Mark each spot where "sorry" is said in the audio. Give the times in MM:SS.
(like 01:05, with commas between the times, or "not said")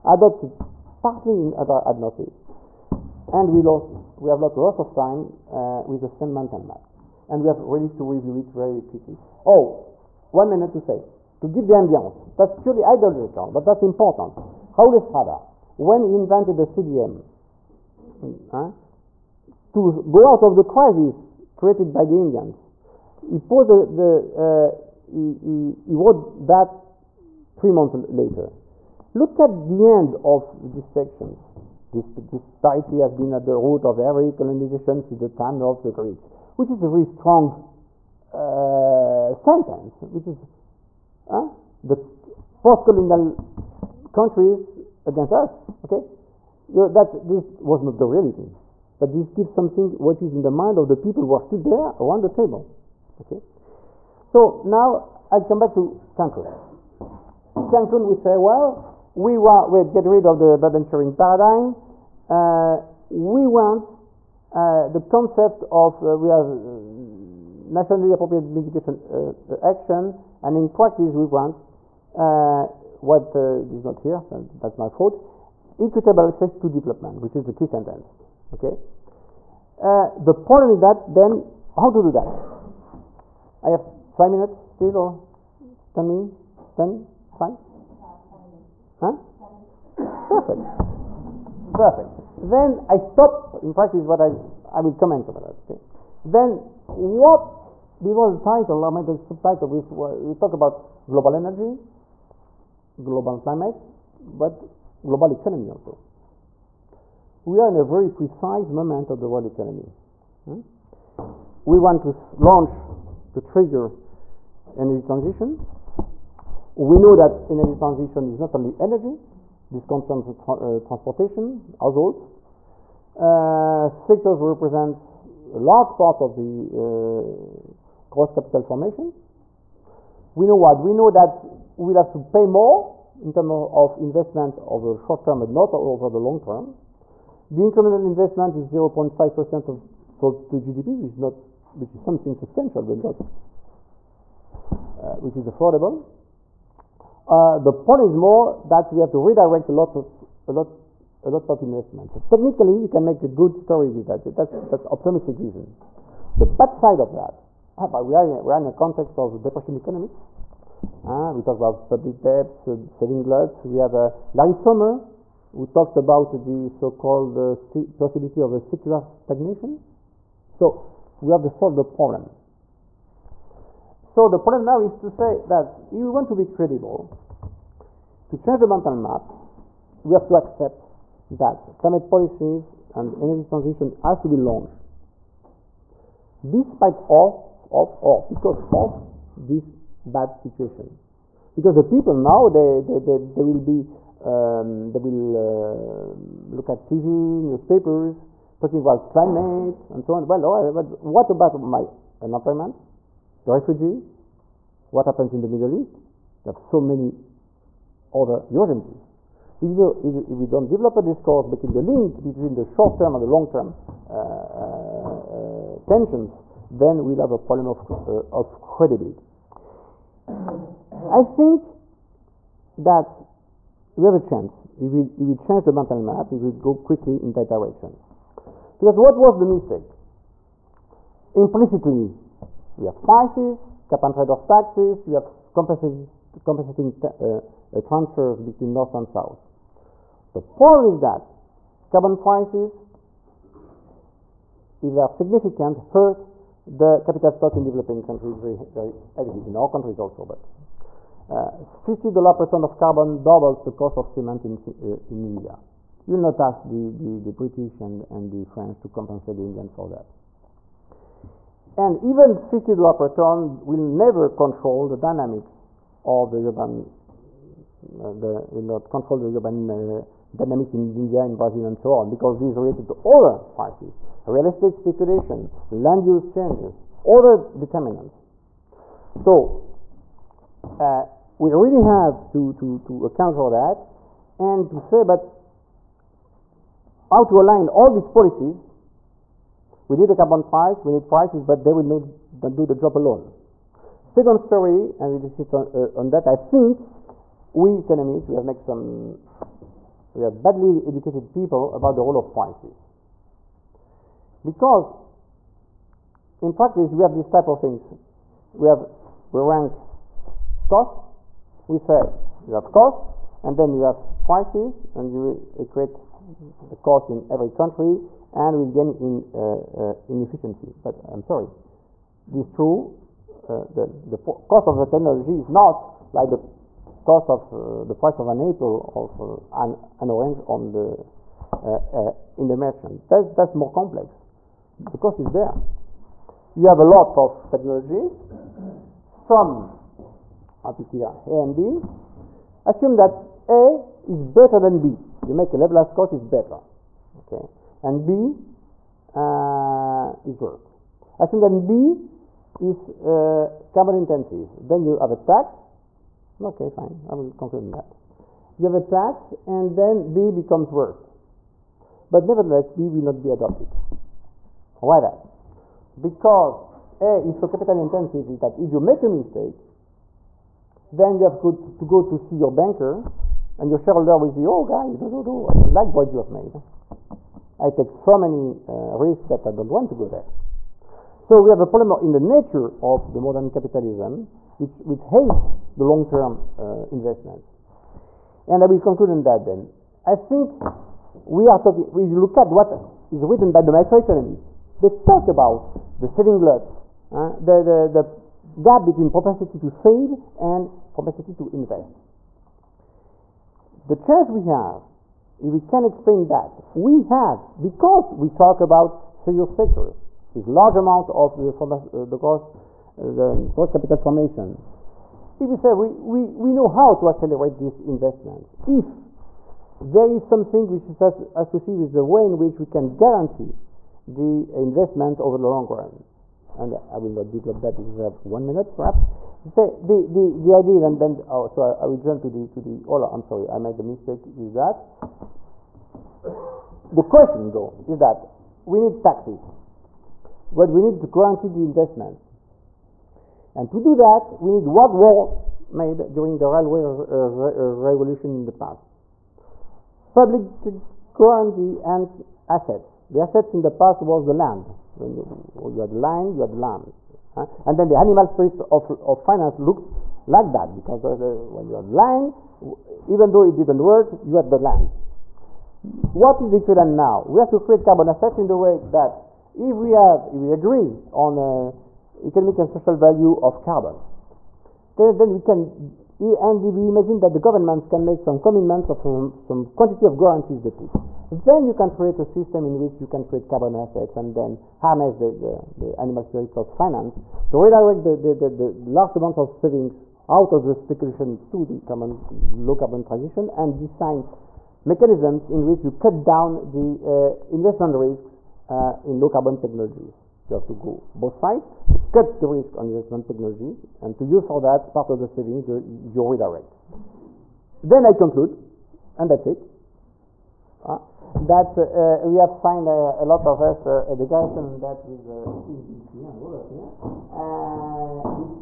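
05:21, 07:13.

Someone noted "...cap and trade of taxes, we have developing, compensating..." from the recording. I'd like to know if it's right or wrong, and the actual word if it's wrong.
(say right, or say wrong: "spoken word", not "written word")
wrong: "compensating", not "developing".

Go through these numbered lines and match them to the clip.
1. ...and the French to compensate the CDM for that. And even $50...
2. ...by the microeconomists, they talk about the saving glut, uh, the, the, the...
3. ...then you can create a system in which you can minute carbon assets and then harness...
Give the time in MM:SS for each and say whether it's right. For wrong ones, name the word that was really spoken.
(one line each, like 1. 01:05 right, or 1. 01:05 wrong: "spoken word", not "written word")
1. 04:18 wrong: "Indians", not "CDM"
2. 06:33 right
3. 08:01 wrong: "create", not "minute".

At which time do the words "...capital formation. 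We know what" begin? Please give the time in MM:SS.
02:08.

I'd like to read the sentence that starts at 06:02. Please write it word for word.
But nevertheless, B will not be adopted.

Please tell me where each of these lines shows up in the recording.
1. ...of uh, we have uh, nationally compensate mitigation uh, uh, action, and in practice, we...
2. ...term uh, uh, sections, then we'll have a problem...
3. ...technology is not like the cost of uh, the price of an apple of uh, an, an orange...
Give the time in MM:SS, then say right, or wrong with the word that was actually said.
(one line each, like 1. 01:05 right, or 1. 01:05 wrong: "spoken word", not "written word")
1. 01:05 wrong: "appropriate", not "compensate"
2. 03:33 wrong: "tensions", not "sections"
3. 05:24 right.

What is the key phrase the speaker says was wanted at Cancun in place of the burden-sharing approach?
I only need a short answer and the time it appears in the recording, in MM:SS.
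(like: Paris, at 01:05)
Equitable access to development, at 01:15.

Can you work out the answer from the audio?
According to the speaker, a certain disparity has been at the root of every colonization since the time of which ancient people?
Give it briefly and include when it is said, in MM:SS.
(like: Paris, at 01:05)
The Greeks, at 00:35.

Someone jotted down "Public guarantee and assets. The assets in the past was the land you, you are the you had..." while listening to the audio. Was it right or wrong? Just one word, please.
right.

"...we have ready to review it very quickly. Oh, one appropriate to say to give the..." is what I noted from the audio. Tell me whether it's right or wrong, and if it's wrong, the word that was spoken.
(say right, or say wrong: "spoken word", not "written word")
wrong: "minute", not "appropriate".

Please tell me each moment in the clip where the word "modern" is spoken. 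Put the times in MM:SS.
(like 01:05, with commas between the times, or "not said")
06:23.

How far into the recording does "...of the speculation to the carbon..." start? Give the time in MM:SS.
08:10.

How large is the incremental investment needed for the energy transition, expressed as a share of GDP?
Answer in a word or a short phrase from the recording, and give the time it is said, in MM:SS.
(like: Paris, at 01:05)
0.5%, at 02:18.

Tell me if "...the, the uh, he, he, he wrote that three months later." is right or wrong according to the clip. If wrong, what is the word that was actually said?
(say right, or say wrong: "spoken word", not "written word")
right.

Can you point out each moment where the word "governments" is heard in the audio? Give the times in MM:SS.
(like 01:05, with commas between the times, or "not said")
07:57.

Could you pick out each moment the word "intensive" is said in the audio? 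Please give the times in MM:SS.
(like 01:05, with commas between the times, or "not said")
05:53, 06:07.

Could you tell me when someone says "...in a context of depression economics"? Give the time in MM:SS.
02:38.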